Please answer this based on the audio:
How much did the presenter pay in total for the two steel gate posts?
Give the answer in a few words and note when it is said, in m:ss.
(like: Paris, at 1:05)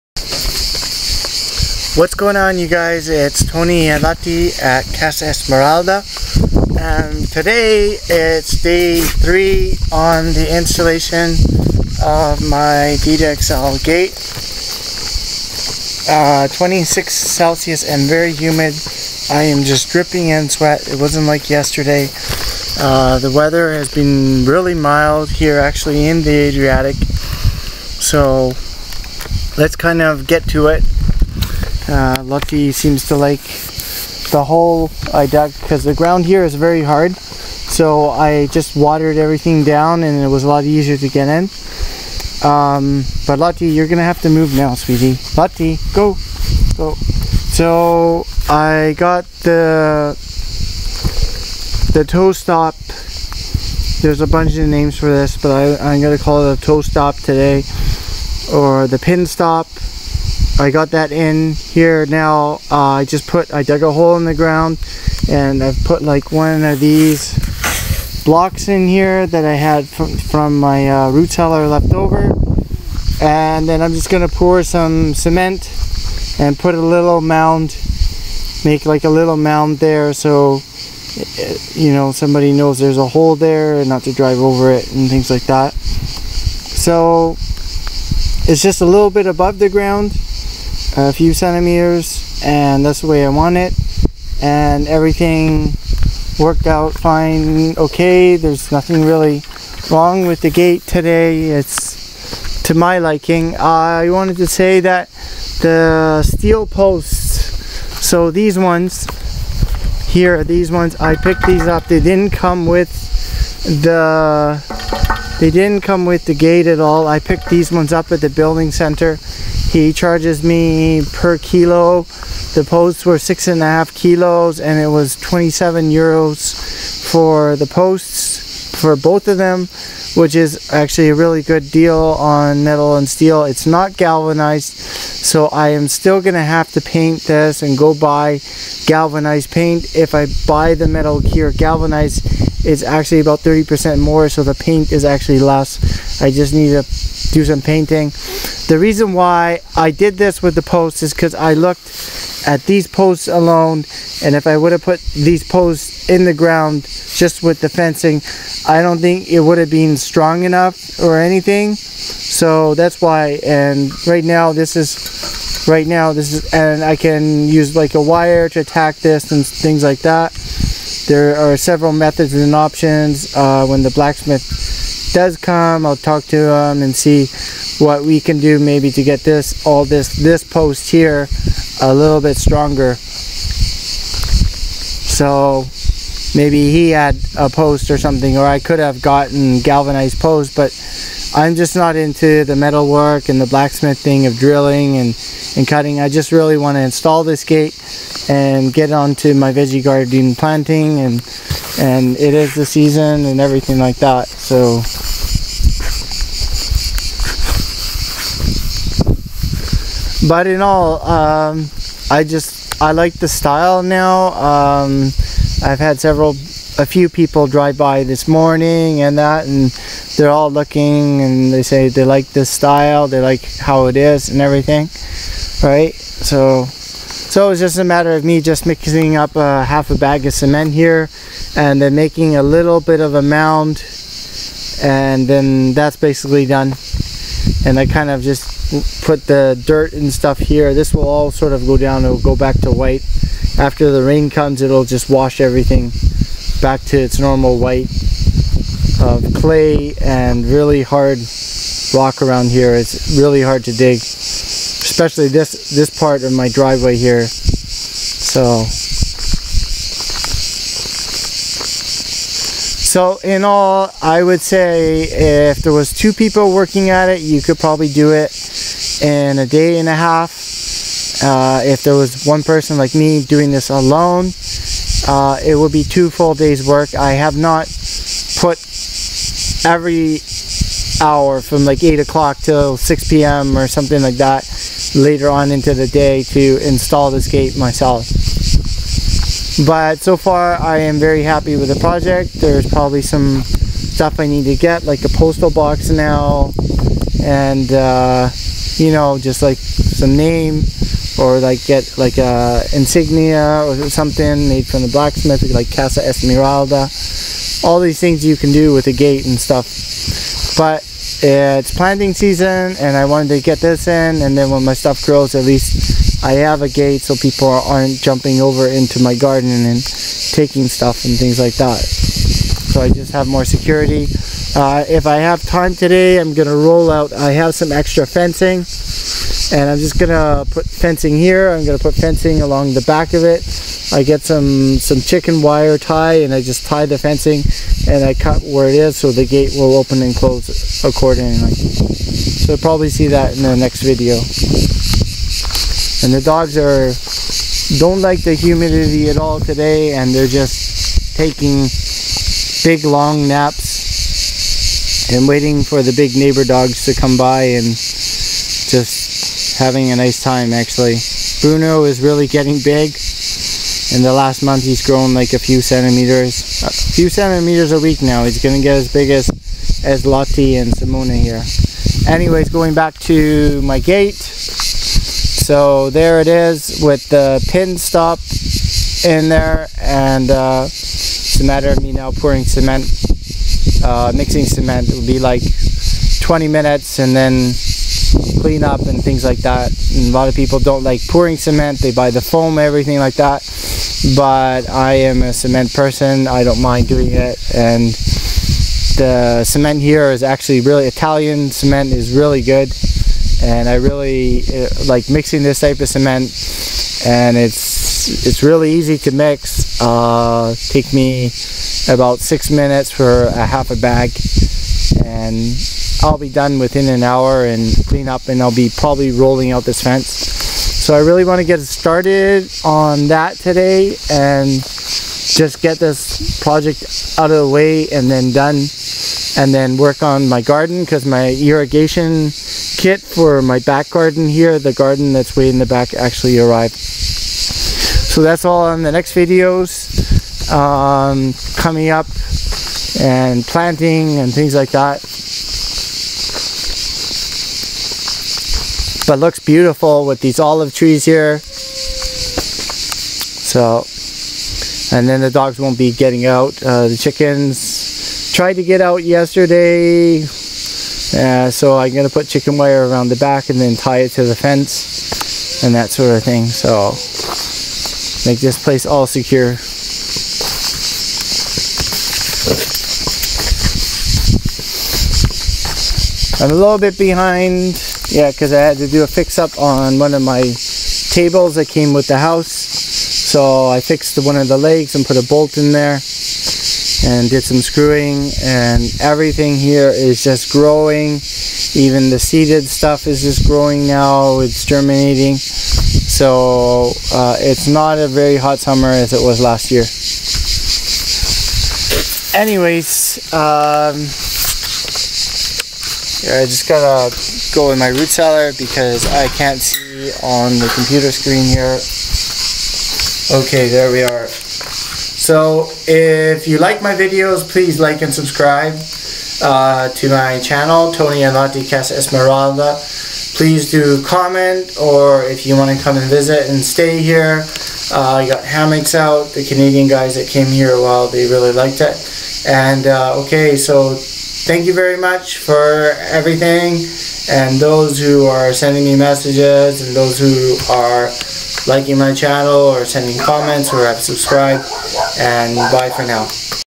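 27 euros, at 2:05.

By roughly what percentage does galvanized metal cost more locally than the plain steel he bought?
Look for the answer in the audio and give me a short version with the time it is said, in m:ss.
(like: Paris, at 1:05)
30%, at 2:23.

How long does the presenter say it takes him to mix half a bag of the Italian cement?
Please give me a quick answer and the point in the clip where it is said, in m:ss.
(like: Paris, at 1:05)
six minutes, at 6:52.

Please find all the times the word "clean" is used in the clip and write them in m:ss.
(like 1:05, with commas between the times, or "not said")
6:28, 6:57.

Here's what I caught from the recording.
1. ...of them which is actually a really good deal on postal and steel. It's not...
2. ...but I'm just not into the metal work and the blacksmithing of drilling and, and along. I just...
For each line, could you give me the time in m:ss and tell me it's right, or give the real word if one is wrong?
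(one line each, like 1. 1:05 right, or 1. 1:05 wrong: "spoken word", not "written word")
1. 2:09 wrong: "metal", not "postal"
2. 3:10 wrong: "cutting", not "along".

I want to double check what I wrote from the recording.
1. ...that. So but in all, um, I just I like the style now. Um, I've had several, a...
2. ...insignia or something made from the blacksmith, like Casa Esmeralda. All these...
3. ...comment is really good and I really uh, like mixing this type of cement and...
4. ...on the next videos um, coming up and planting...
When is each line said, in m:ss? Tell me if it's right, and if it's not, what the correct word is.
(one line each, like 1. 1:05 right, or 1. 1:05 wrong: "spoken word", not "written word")
1. 3:23 right
2. 5:02 right
3. 6:41 wrong: "cement", not "comment"
4. 7:18 right.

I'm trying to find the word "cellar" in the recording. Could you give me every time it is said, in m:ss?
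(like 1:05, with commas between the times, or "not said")
1:11, 8:28.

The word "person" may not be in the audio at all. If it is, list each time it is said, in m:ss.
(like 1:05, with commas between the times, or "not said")
4:32, 6:35.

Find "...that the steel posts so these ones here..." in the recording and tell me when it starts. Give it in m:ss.
1:44.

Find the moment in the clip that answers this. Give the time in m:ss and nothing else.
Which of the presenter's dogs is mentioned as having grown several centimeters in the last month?
6:01.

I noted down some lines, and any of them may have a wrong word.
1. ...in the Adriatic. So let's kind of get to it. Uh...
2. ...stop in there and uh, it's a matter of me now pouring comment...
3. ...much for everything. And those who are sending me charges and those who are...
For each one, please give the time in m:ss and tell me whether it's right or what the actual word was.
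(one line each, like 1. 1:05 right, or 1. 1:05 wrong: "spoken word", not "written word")
1. 0:26 right
2. 6:17 wrong: "cement", not "comment"
3. 8:54 wrong: "messages", not "charges".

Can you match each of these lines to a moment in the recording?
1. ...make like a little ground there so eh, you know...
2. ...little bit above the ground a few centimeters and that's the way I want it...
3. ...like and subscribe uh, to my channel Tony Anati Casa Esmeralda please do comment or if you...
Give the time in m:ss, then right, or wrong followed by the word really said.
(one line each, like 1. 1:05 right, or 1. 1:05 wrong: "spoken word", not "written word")
1. 1:18 wrong: "mound", not "ground"
2. 1:28 right
3. 8:37 right.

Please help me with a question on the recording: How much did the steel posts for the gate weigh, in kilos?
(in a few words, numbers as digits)
6.5 kilos.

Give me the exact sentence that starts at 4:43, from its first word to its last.
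or something like that later on into the day to install this gate myself.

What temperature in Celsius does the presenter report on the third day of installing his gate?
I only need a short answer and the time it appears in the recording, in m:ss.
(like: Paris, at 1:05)
26, at 0:16.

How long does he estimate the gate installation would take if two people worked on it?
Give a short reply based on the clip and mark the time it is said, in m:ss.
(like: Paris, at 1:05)
a day and a half, at 4:29.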